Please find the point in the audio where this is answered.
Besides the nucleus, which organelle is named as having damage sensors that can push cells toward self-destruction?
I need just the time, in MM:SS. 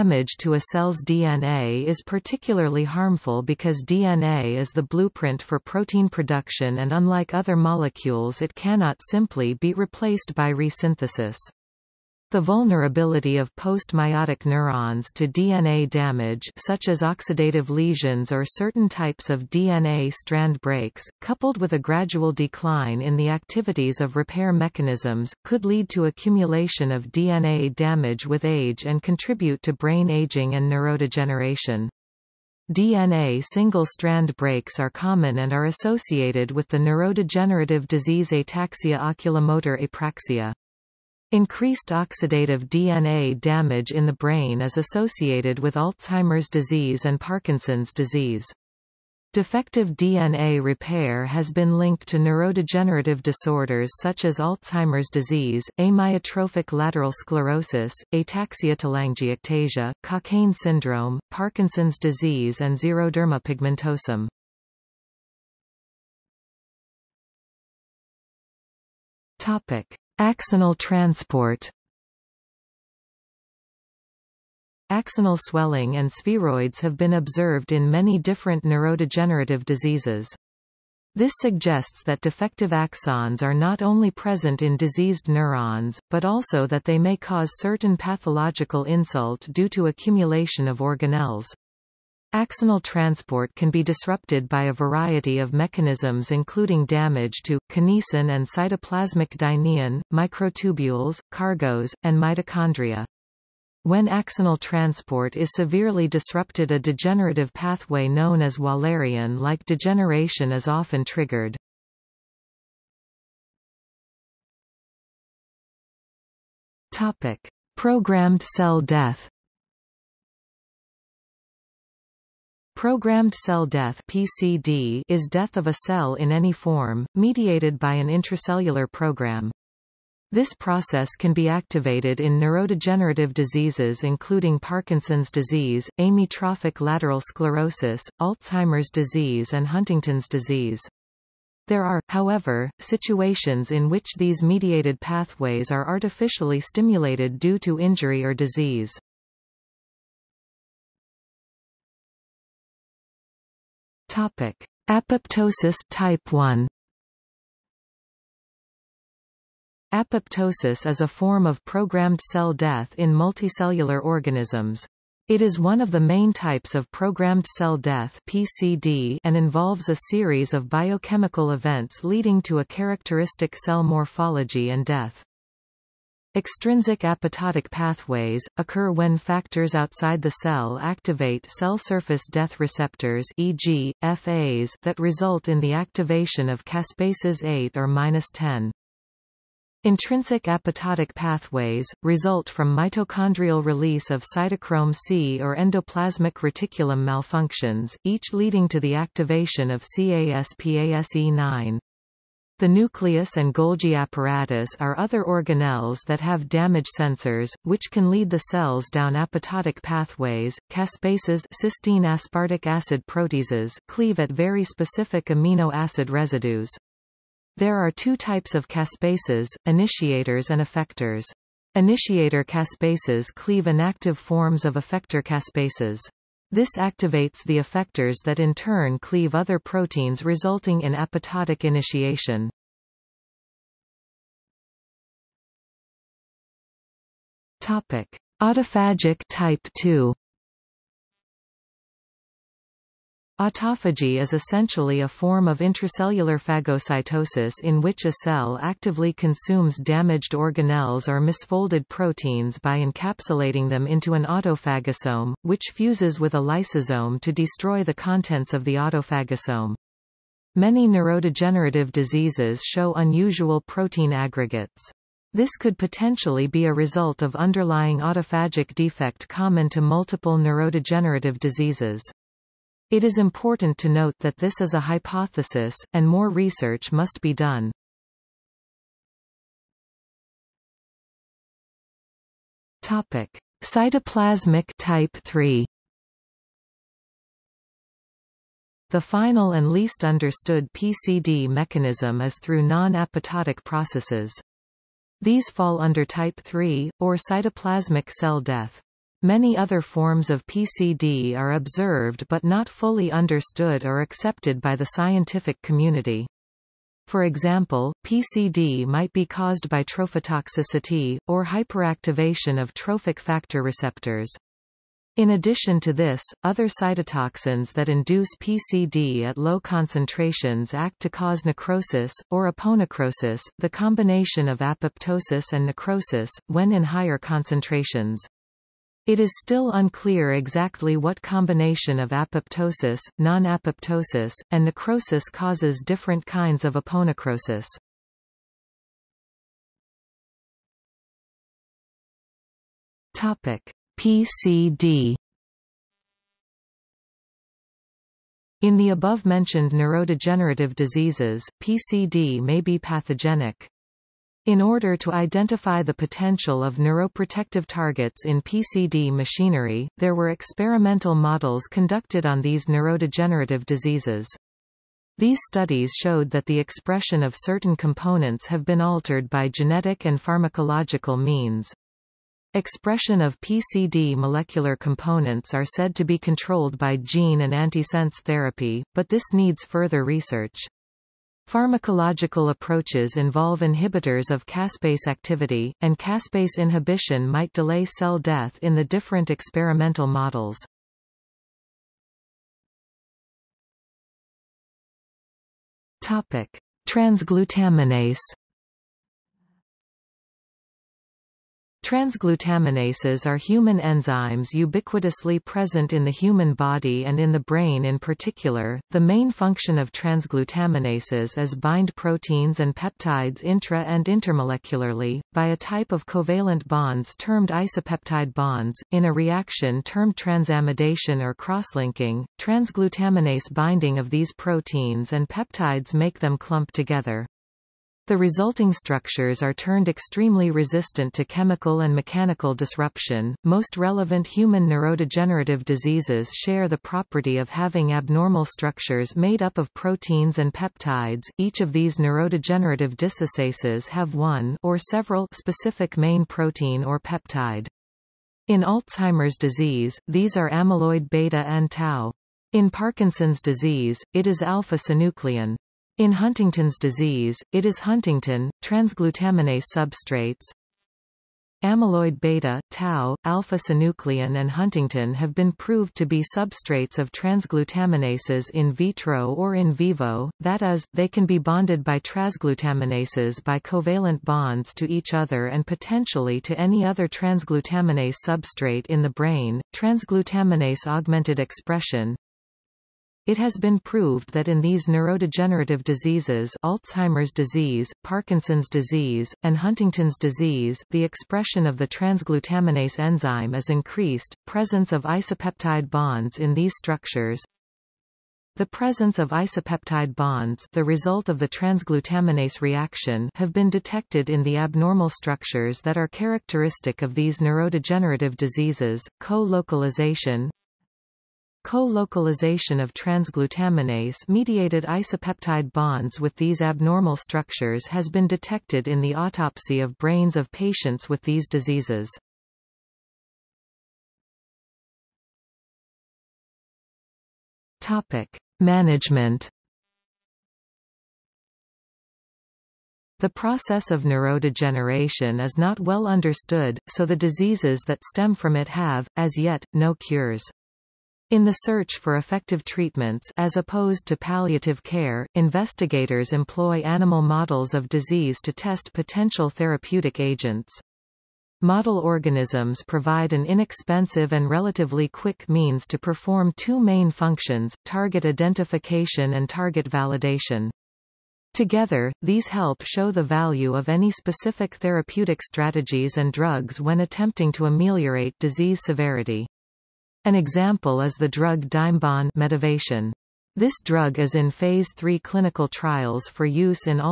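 03:23.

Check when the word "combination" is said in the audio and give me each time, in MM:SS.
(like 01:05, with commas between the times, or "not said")
05:23, 05:31.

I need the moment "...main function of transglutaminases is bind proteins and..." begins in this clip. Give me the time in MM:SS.
06:49.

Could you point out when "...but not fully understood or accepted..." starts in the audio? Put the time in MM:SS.
05:02.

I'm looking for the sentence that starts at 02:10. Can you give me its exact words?
This process can be activated in neurodegenerative diseases including Parkinson's disease, amyotrophic lateral sclerosis, Alzheimer's disease and Huntington's disease.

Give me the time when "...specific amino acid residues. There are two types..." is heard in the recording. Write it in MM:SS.
03:34.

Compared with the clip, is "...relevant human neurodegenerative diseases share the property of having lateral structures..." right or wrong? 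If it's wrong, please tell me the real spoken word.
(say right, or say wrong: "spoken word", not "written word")
wrong: "abnormal", not "lateral".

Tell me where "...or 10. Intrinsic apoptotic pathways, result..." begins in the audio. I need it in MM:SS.
03:07.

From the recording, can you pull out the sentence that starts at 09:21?
Together, these help show the value of any specific therapeutic strategies and drugs when attempting to ameliorate disease severity.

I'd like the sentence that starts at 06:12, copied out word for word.
Expression of PCD molecular components are said to be controlled by gene and antisense therapy, but this needs further research.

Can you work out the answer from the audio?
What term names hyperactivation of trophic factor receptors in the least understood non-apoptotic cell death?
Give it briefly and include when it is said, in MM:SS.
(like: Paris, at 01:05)
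trophotoxicity, at 05:09.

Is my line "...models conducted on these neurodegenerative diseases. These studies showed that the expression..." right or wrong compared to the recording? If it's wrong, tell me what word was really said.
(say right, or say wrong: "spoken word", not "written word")
right.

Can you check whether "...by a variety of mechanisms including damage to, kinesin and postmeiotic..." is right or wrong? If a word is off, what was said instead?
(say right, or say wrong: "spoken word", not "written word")
wrong: "cytoplasmic", not "postmeiotic".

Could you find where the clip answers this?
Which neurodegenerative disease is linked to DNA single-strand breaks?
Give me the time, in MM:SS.
00:38.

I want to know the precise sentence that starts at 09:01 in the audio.
In the search for effective treatments as opposed to palliative care, investigators employ animal models of disease to test potential therapeutic agents.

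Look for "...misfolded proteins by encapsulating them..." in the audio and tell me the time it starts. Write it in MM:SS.
04:11.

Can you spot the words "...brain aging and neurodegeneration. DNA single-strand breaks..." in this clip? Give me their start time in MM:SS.
00:29.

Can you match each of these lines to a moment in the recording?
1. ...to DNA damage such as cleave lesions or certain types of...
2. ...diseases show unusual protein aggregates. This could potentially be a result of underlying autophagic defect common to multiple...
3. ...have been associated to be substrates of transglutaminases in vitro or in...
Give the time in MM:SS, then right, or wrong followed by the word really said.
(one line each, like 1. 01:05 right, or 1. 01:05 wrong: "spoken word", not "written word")
1. 00:15 wrong: "oxidative", not "cleave"
2. 04:21 right
3. 07:45 wrong: "proved", not "associated".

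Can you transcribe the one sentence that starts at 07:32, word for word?
In Parkinson's disease, it is alpha-synuclein.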